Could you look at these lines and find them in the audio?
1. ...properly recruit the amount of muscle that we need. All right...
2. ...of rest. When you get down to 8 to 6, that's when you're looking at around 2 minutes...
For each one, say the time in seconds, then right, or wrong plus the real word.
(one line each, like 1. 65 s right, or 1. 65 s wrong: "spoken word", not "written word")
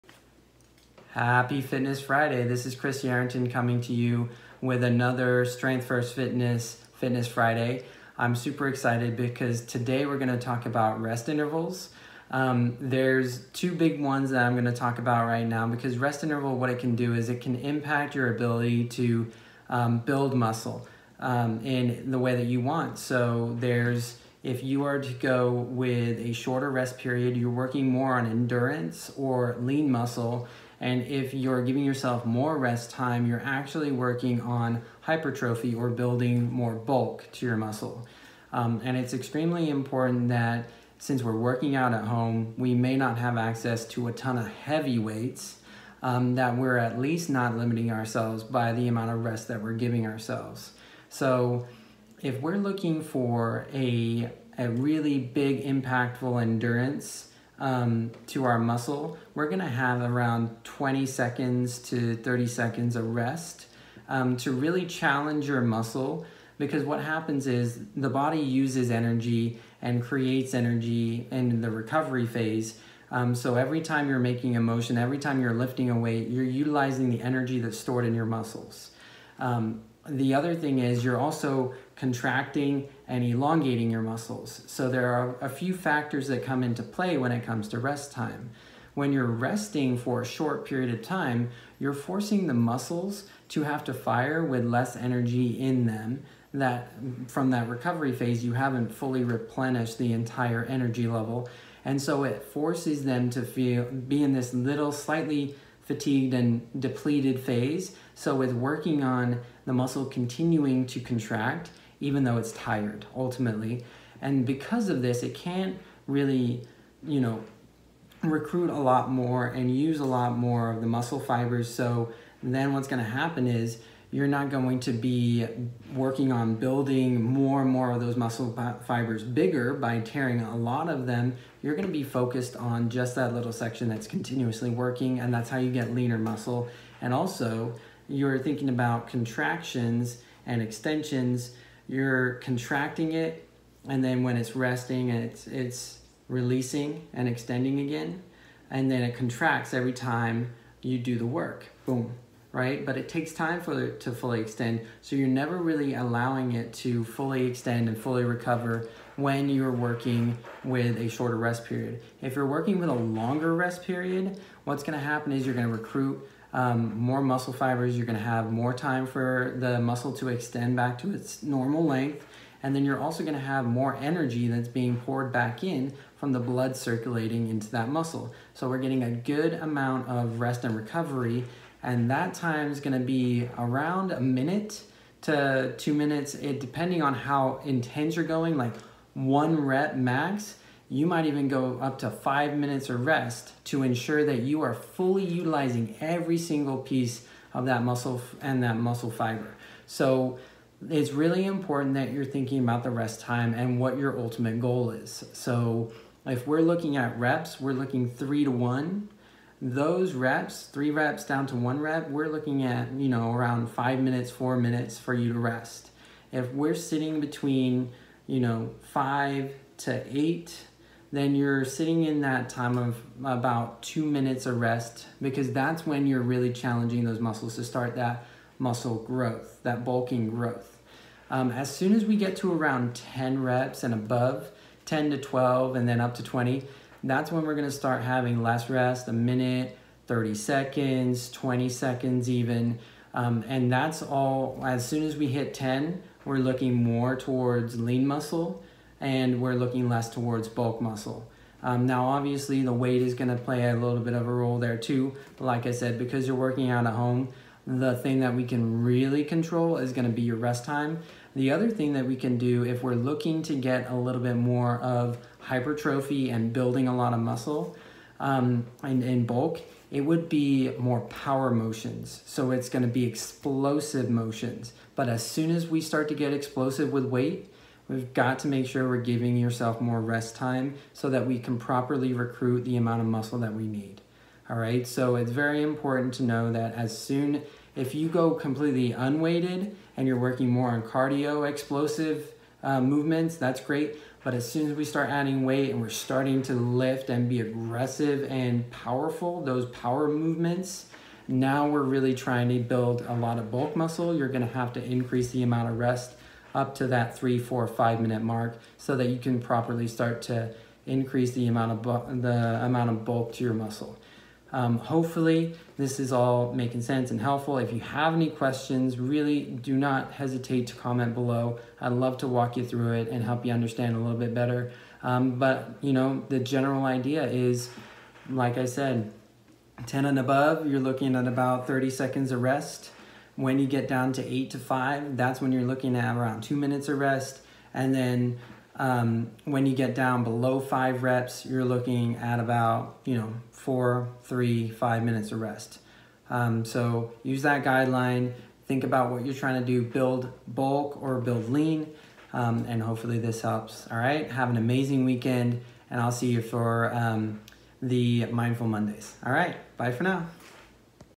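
1. 281 s right
2. 332 s wrong: "5", not "6".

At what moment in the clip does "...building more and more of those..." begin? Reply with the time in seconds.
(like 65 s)
126 s.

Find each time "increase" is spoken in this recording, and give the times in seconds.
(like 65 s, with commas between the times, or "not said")
304 s, 310 s.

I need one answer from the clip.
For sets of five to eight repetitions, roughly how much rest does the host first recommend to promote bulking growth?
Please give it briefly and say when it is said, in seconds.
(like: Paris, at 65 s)
2 minutes, at 223 s.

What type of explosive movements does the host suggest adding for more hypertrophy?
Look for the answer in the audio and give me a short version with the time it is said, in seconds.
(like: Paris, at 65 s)
power motions, at 271 s.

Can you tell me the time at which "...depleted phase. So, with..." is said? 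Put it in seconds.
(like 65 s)
106 s.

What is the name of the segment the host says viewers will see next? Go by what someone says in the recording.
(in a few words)
Mindful Mondays.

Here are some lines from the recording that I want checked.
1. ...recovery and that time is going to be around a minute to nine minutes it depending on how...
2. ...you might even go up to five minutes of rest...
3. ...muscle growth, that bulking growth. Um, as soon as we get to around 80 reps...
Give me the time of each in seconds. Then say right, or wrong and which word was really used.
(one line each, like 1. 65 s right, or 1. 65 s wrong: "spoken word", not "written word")
1. 180 s wrong: "two", not "nine"
2. 190 s right
3. 228 s wrong: "10", not "80".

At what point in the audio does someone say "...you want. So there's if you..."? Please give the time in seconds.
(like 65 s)
22 s.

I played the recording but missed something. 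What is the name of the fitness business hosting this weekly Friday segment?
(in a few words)
Strength First Fitness.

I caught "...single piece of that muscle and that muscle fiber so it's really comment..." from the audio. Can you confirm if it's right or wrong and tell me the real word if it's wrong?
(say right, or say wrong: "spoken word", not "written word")
wrong: "important", not "comment".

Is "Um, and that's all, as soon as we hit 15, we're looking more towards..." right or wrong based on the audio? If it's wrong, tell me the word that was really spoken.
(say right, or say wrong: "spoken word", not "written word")
wrong: "10", not "15".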